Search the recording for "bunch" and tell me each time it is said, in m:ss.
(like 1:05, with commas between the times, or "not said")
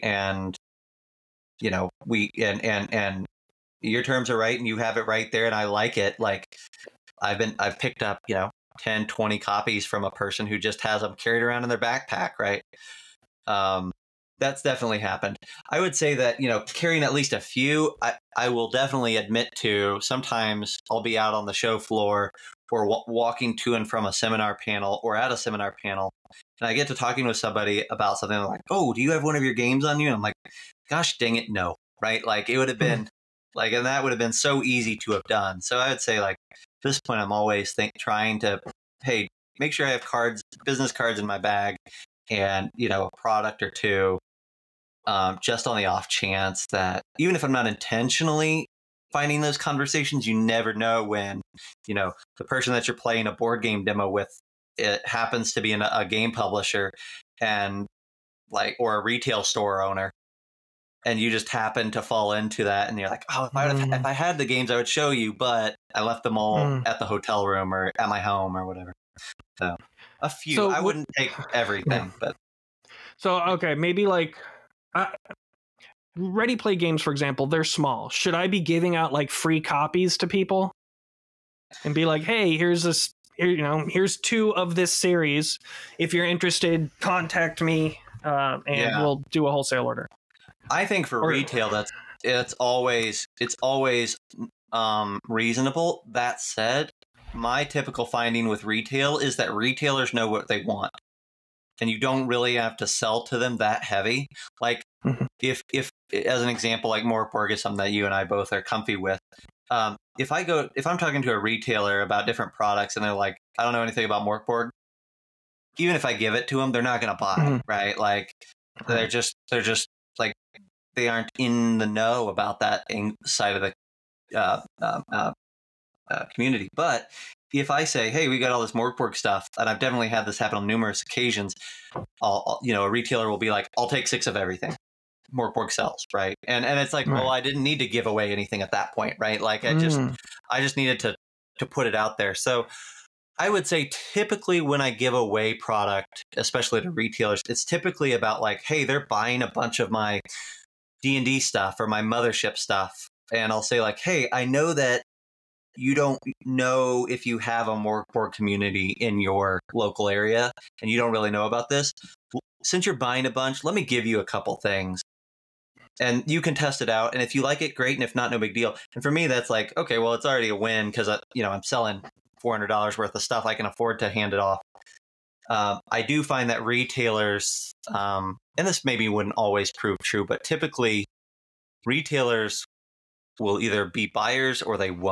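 2:29, 2:43.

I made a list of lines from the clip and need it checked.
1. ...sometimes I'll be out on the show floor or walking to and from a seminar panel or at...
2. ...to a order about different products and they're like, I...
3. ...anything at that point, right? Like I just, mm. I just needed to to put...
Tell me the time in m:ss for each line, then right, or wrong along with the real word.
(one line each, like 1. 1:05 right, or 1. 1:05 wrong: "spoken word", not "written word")
1. 0:19 right
2. 1:51 wrong: "retailer", not "order"
3. 2:18 right.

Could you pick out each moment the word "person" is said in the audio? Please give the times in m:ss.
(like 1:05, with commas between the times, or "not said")
0:10, 0:52.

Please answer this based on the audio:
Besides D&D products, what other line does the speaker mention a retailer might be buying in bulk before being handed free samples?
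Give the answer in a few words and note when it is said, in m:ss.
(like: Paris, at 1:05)
Mothership, at 2:32.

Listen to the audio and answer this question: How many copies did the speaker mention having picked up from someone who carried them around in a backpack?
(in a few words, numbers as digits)
10, 20.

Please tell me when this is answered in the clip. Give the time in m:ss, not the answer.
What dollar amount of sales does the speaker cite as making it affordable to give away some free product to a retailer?
2:52.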